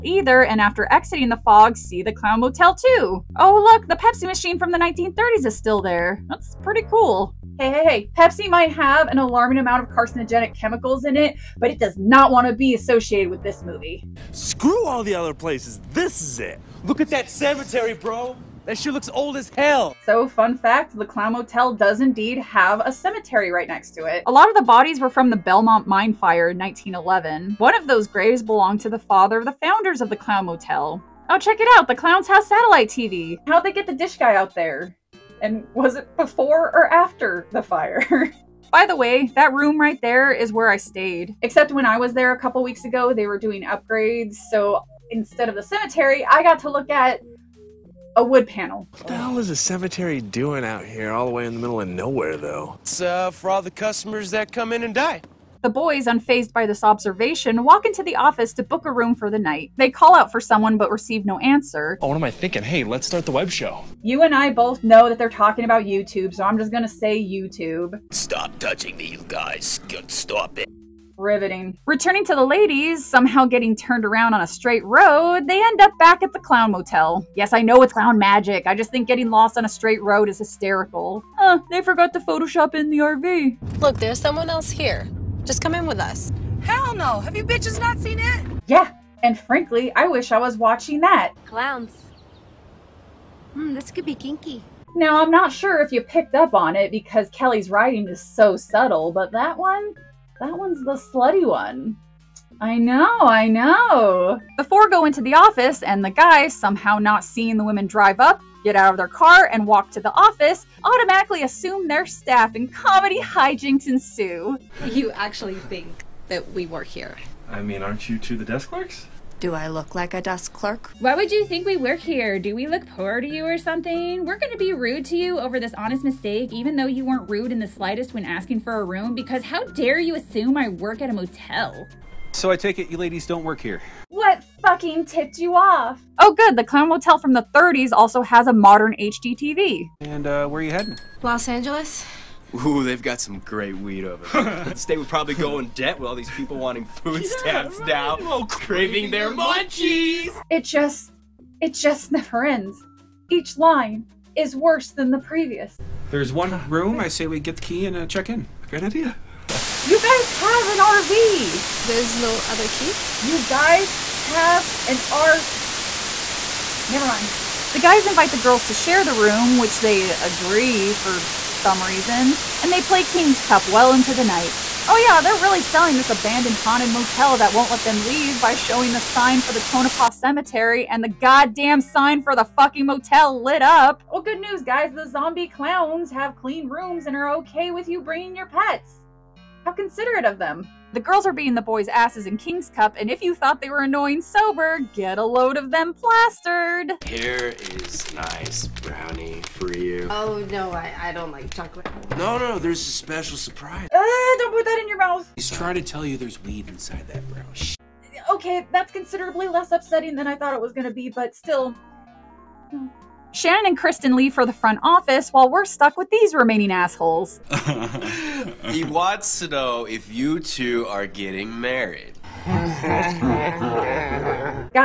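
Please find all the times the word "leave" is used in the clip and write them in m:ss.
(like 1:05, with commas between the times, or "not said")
2:58, 3:34.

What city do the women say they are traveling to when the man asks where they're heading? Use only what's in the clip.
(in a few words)
Los Angeles.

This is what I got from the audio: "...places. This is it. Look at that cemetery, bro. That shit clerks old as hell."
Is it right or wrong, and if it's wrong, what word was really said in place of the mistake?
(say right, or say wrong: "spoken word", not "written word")
wrong: "looks", not "clerks".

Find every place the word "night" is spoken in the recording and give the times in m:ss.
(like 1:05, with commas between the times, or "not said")
0:59, 2:54.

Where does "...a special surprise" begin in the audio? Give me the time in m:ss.
3:22.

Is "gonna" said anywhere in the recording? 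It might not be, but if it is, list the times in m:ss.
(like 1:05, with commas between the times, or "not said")
1:06, 2:04.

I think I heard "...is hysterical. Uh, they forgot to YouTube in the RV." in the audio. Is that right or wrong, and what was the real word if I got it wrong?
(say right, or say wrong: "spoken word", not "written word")
wrong: "Photoshop", not "YouTube".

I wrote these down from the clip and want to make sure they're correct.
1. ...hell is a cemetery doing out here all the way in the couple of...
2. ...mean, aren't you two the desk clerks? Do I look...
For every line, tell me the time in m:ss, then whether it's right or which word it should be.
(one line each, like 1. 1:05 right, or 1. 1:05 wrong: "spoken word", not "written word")
1. 0:49 wrong: "middle", not "couple"
2. 1:57 right.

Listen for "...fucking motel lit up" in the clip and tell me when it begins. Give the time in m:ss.
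3:02.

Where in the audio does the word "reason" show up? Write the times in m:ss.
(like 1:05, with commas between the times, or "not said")
2:51.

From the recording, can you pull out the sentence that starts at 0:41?
Except when I was there a couple weeks ago, they were doing upgrades.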